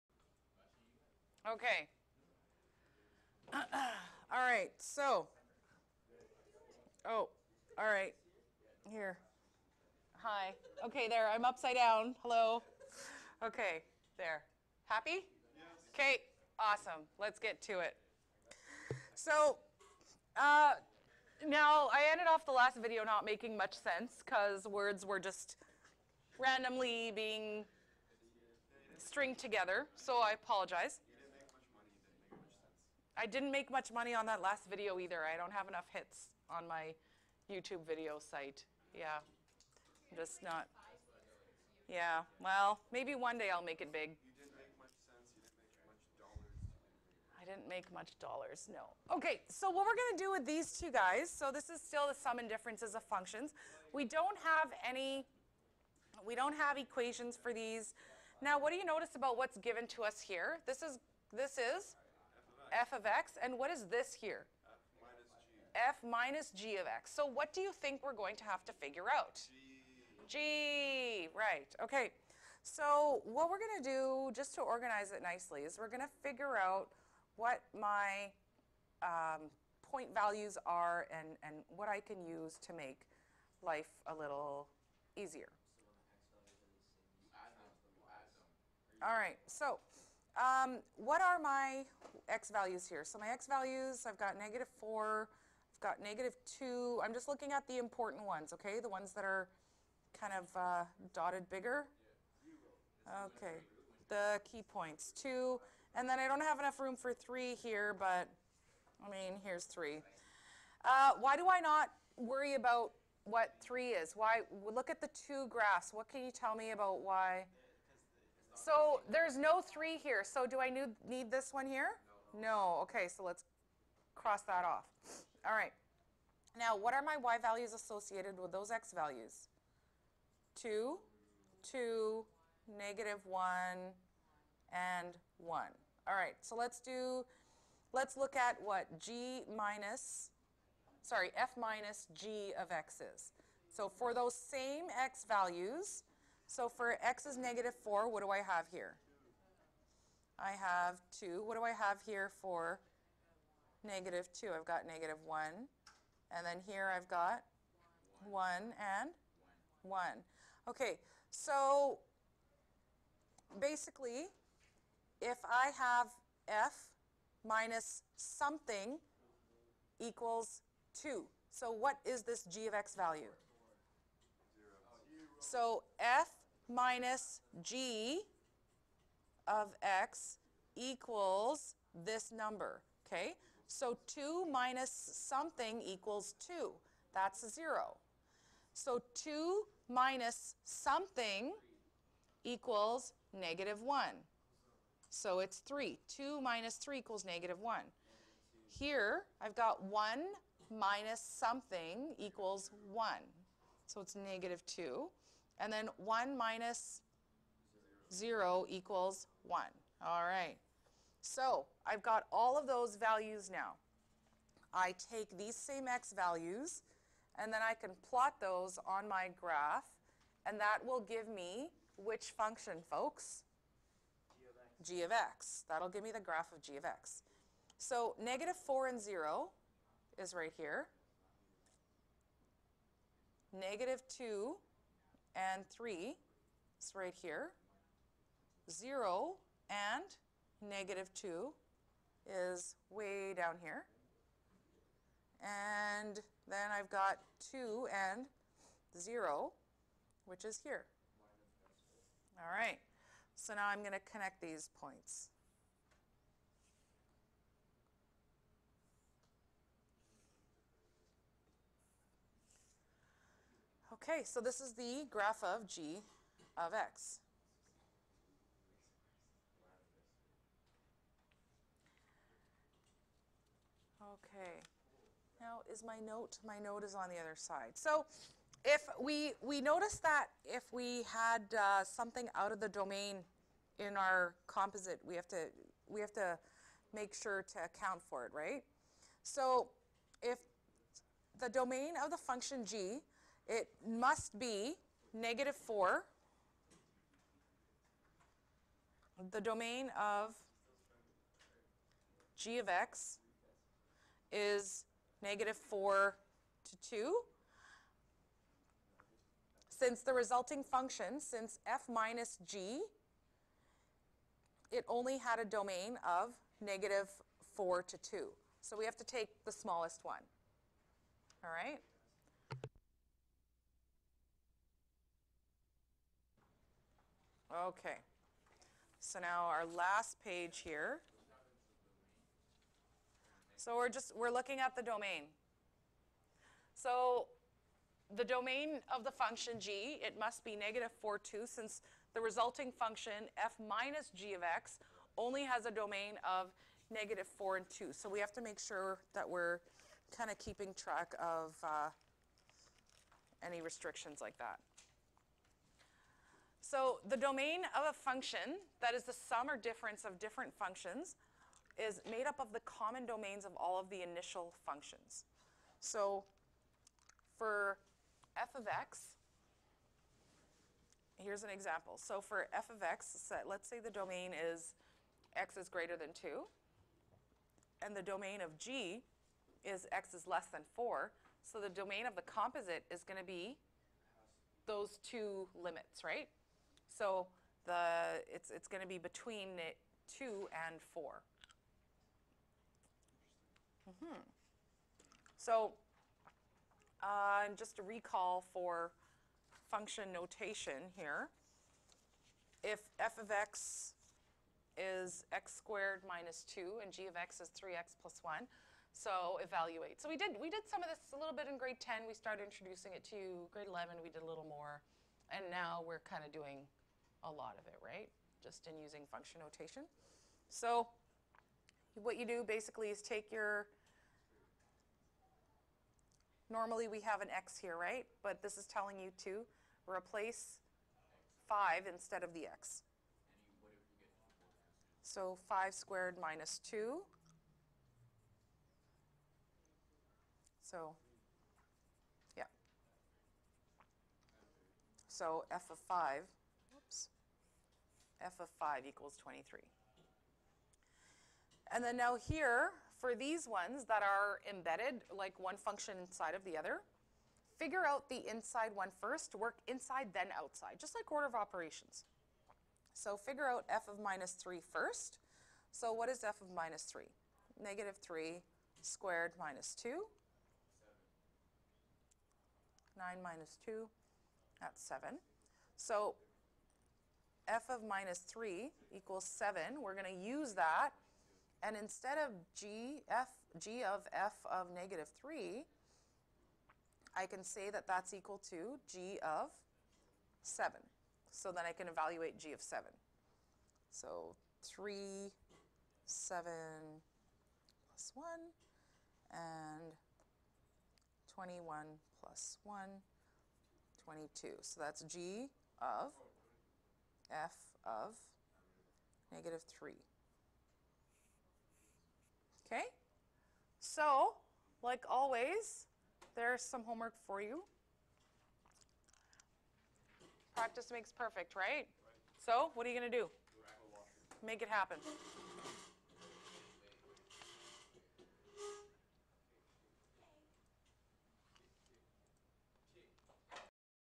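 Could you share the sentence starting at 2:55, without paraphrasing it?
So f minus g of x equals this number, okay?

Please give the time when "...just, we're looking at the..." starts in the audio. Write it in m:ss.
5:33.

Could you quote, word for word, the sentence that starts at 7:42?
So figure out f of minus 3 first.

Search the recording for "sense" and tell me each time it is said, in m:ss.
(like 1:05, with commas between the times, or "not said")
0:23, 0:45.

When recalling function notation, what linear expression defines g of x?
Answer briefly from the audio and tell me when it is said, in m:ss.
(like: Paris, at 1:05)
3x + 1, at 6:47.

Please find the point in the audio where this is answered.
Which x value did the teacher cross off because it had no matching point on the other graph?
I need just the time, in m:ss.
1:49.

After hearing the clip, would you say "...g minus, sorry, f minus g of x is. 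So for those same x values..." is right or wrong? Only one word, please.
right.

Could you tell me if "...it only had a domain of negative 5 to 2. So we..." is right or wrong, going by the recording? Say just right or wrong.
wrong.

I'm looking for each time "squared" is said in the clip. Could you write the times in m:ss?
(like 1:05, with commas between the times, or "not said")
6:45, 7:15, 7:48.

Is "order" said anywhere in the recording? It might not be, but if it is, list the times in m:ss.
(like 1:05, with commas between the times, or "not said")
7:41.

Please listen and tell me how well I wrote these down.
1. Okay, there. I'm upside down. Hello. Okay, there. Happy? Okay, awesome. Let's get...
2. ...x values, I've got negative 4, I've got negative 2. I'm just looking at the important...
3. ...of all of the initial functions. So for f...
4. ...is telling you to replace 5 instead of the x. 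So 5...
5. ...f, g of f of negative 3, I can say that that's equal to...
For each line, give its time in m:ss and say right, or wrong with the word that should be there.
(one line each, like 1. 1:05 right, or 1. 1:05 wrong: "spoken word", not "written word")
1. 0:10 right
2. 1:33 right
3. 6:03 right
4. 7:08 right
5. 8:03 right.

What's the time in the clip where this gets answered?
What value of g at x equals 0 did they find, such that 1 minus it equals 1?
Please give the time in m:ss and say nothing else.
3:23.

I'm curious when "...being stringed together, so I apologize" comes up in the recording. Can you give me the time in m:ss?
0:27.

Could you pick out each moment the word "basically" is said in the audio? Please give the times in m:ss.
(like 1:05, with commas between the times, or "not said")
2:43, 7:02.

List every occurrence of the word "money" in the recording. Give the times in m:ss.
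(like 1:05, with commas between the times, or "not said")
0:33.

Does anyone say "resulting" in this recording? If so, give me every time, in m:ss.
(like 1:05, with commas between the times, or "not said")
5:10, 5:42.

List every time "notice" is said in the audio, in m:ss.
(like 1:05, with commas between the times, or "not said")
0:58, 4:39.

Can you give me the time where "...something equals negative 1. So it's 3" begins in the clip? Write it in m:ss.
3:10.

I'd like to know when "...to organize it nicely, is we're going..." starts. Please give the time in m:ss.
1:14.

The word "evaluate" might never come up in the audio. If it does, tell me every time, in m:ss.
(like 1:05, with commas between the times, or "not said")
6:49, 8:11.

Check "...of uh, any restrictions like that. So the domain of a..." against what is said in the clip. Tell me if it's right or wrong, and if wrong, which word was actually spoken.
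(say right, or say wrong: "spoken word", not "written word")
right.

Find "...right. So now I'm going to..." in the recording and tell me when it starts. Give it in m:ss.
4:12.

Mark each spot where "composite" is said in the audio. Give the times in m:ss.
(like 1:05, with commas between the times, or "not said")
4:44, 6:22.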